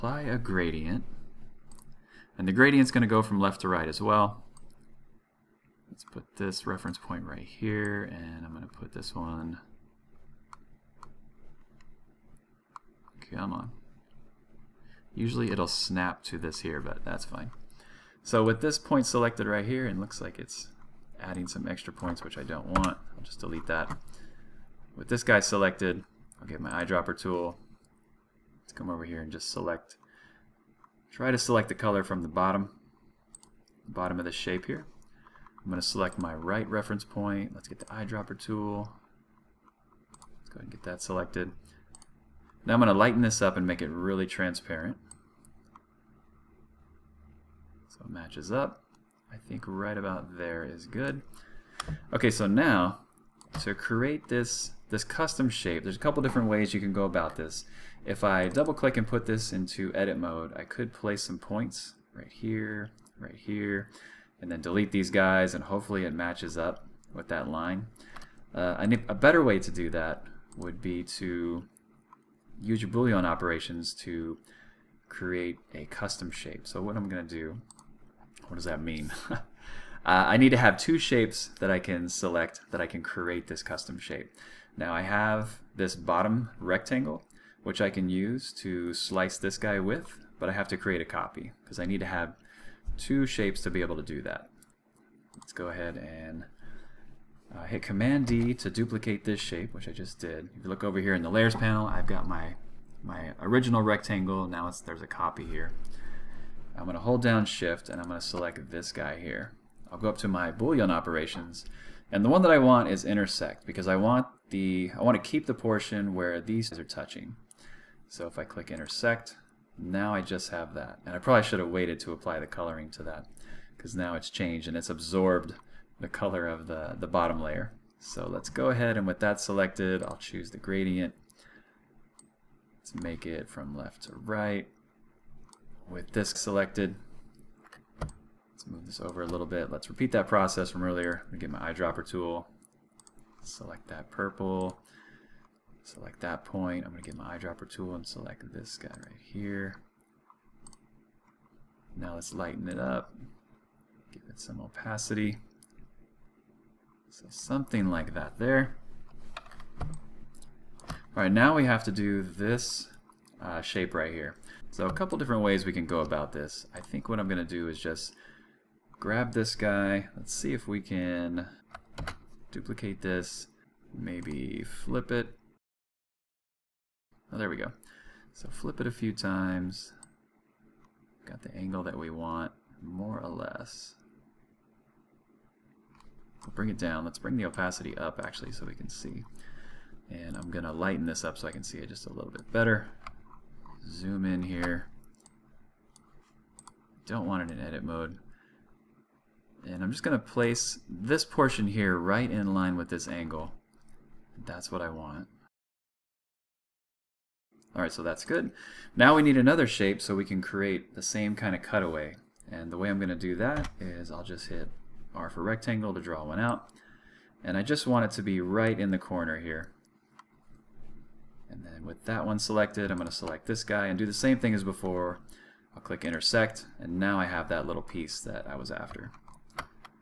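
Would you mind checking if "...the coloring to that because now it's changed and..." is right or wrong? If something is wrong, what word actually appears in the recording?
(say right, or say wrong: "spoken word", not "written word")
right.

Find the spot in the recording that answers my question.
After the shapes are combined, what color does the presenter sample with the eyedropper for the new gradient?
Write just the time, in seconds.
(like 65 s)
144 s.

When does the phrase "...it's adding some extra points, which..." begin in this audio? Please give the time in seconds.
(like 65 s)
20 s.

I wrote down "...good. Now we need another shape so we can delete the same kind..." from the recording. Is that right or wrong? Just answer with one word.
wrong.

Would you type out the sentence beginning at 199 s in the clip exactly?
And I'm just going to place this portion here right in line with this angle.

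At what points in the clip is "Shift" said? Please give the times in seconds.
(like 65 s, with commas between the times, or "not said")
107 s.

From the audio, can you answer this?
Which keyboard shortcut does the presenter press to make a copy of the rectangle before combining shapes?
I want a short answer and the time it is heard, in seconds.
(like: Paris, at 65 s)
Command D, at 97 s.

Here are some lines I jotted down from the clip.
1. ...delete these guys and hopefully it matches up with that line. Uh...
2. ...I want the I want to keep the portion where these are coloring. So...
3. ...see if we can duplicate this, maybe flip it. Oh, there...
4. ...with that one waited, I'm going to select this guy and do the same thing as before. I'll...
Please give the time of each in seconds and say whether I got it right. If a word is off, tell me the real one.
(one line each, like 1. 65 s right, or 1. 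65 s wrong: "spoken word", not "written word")
1. 64 s right
2. 113 s wrong: "touching", not "coloring"
3. 170 s right
4. 221 s wrong: "selected", not "waited".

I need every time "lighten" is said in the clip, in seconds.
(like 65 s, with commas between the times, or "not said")
42 s, 152 s, 190 s.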